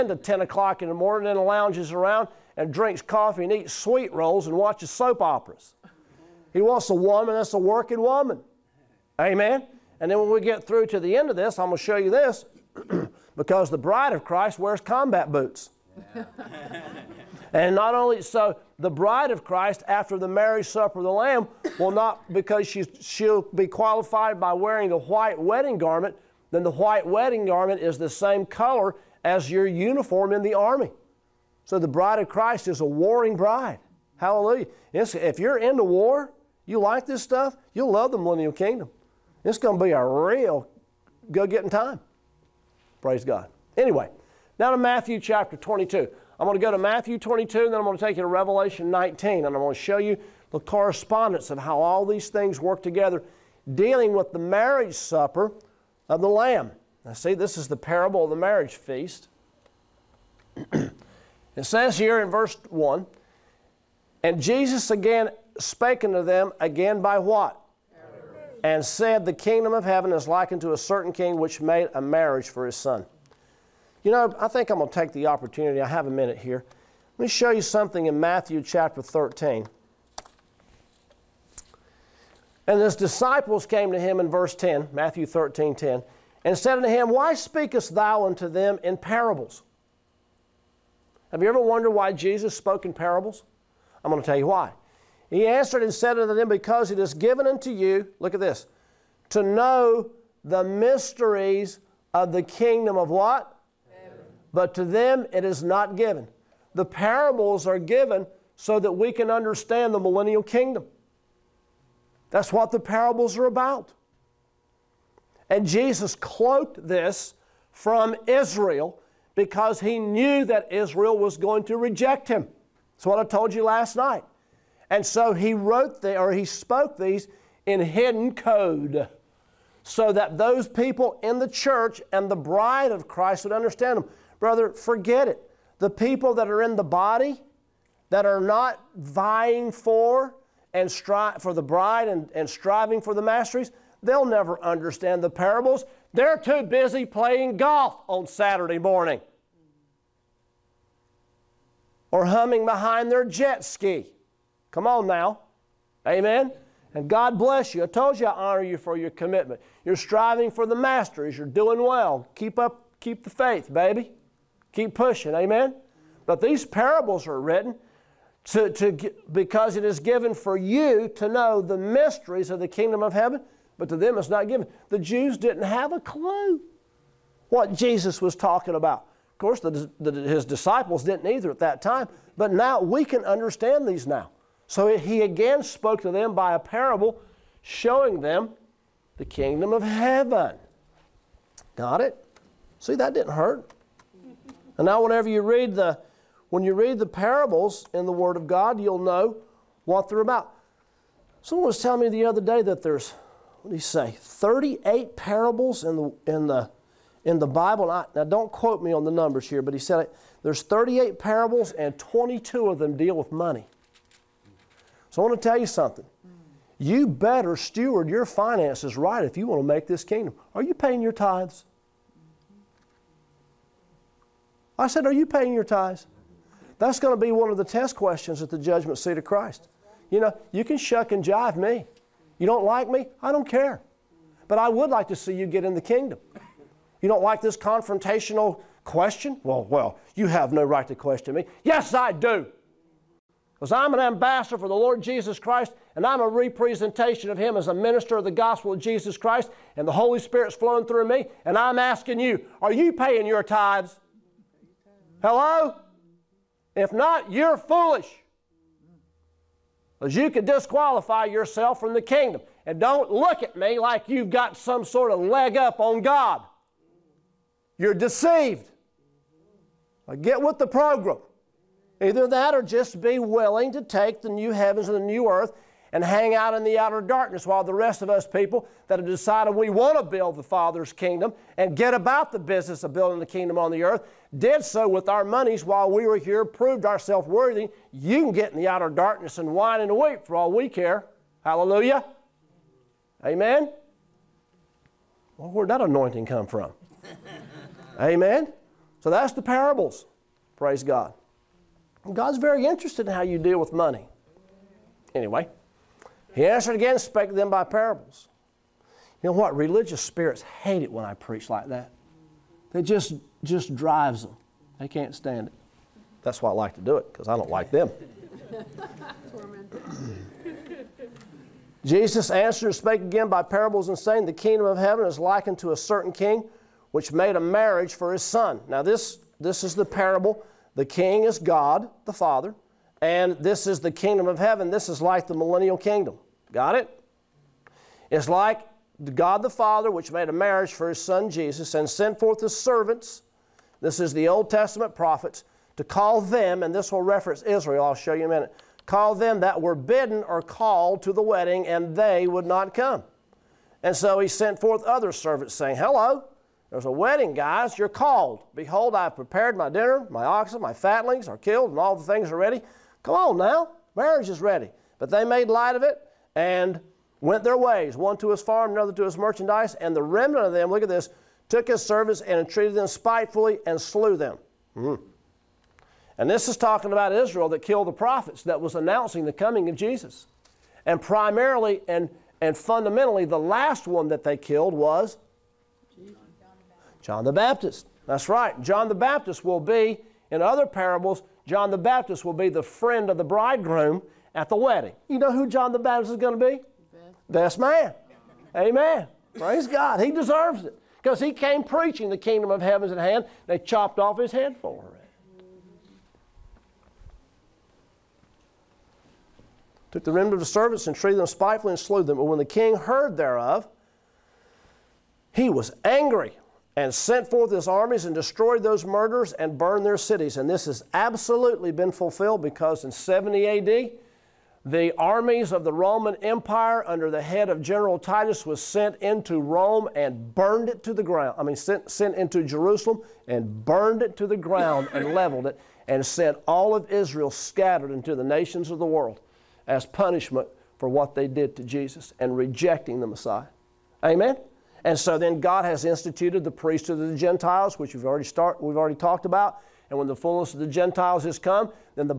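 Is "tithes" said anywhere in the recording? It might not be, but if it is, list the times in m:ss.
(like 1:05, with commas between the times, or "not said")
3:41, 3:45, 4:13.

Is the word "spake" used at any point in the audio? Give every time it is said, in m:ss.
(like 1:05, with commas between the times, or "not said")
1:05, 5:06, 5:22.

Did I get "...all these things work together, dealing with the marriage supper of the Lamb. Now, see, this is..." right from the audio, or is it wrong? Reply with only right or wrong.
right.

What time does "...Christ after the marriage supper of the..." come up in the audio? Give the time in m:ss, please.
0:19.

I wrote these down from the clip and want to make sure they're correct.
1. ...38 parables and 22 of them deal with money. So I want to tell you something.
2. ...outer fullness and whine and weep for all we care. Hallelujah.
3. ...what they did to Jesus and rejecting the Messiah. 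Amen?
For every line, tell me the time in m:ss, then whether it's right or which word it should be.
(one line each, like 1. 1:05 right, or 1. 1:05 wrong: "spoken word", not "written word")
1. 3:30 right
2. 4:48 wrong: "darkness", not "fullness"
3. 7:20 right.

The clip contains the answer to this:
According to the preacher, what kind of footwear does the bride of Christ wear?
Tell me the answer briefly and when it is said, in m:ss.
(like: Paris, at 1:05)
Combat boots, at 0:14.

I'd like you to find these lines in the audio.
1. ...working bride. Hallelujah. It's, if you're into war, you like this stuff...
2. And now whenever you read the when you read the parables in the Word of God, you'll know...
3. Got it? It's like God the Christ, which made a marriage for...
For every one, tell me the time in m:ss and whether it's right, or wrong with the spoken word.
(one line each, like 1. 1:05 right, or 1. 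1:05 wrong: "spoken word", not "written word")
1. 0:32 wrong: "warring", not "working"
2. 3:14 right
3. 5:36 wrong: "Father", not "Christ".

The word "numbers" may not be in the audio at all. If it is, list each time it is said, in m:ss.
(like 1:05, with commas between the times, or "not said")
3:29.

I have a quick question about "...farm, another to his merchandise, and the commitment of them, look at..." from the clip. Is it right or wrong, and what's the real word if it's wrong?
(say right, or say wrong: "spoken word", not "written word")
wrong: "remnant", not "commitment".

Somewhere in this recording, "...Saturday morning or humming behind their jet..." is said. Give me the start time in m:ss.
2:28.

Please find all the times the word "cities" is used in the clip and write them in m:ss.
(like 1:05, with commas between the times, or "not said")
6:59.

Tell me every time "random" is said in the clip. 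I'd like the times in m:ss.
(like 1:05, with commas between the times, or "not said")
not said.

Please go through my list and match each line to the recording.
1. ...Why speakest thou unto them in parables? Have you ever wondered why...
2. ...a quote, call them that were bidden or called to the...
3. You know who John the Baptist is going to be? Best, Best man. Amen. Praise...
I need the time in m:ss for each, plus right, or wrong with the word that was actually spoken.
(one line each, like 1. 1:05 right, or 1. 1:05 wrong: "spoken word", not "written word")
1. 1:27 right
2. 5:48 wrong: "minute", not "quote"
3. 6:35 right.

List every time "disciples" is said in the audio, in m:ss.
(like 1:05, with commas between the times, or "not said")
1:22, 3:00.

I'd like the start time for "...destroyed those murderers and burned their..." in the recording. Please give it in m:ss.
6:58.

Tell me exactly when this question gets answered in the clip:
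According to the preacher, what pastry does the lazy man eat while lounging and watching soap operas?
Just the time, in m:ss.
0:03.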